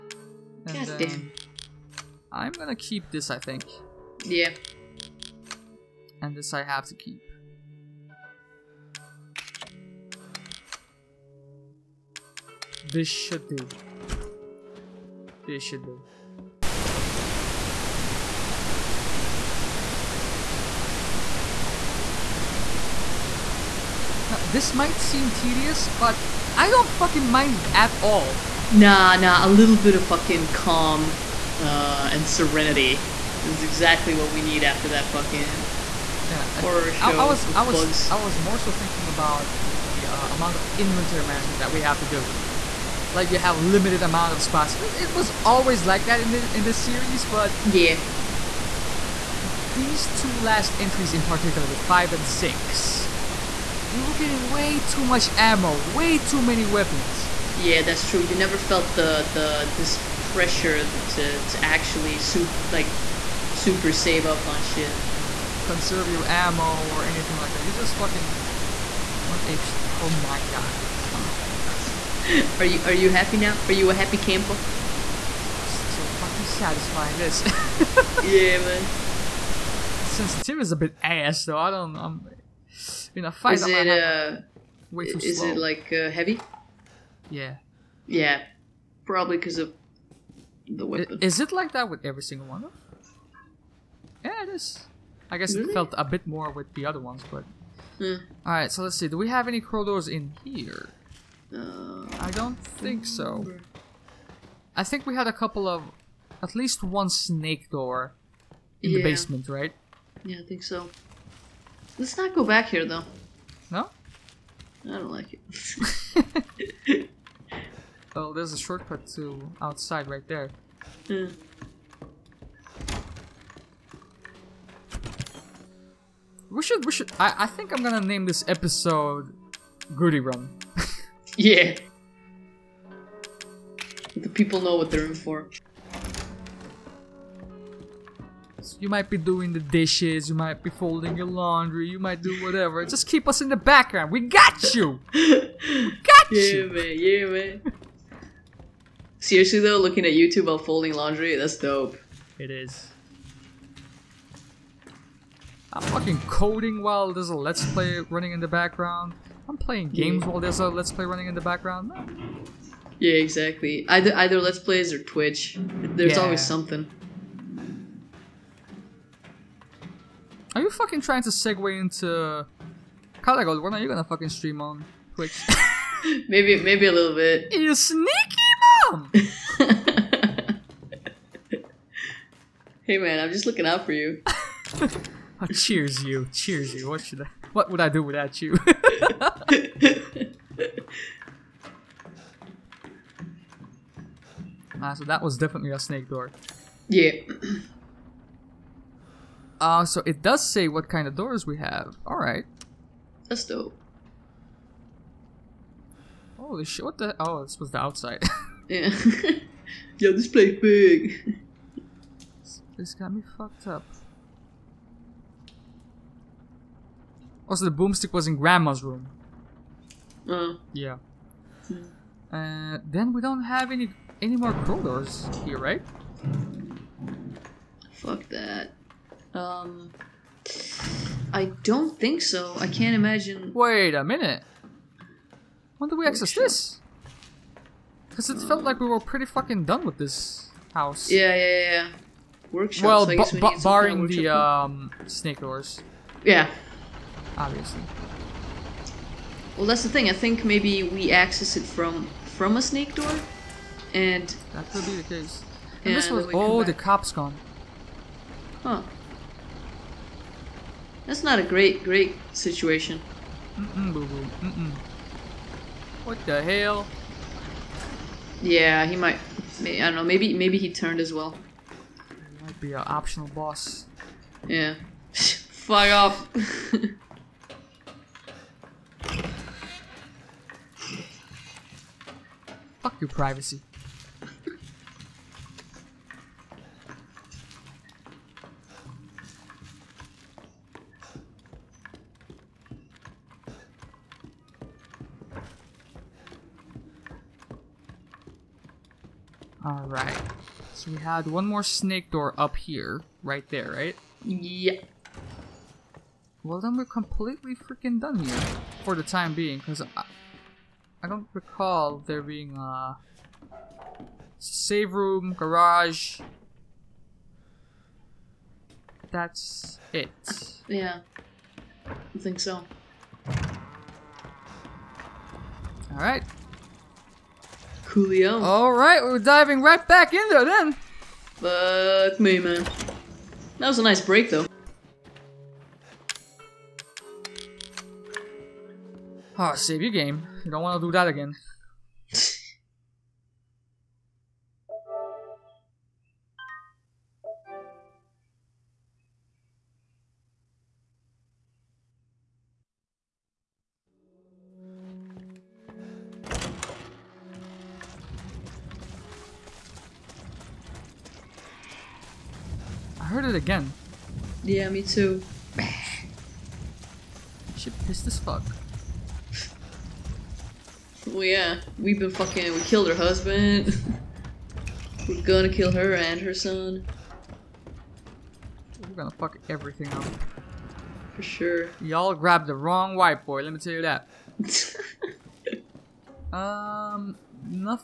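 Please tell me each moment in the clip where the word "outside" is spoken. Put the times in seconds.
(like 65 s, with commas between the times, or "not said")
119 s, 207 s.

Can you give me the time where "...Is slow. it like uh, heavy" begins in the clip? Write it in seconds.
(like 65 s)
85 s.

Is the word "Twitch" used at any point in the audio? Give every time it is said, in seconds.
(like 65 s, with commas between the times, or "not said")
165 s, 175 s.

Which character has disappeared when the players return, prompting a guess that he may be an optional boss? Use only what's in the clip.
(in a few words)
The cop.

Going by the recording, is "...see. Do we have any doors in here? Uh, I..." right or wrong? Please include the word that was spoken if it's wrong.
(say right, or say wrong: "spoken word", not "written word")
wrong: "corridors", not "doors".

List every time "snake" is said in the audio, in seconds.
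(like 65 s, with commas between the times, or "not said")
107 s, 195 s, 245 s, 252 s, 301 s.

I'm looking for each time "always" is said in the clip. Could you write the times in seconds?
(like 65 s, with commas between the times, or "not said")
45 s, 166 s.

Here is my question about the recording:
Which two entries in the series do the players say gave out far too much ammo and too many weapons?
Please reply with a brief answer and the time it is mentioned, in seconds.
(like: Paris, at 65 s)
5 and 6, at 51 s.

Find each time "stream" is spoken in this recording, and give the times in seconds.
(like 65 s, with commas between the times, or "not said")
174 s.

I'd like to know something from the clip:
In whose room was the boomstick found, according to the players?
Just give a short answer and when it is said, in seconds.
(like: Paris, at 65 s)
Grandma's room, at 218 s.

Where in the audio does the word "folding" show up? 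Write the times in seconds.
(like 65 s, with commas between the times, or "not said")
140 s, 150 s.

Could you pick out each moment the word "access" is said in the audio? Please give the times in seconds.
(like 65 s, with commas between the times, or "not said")
236 s, 251 s.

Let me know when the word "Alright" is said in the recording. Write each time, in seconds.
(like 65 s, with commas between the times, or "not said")
202 s, 299 s, 325 s.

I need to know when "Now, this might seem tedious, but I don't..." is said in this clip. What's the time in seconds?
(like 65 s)
24 s.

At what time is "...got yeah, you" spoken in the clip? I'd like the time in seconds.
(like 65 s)
146 s.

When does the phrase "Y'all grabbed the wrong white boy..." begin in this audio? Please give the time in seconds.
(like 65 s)
381 s.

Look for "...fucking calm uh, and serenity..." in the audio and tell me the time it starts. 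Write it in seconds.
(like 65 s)
30 s.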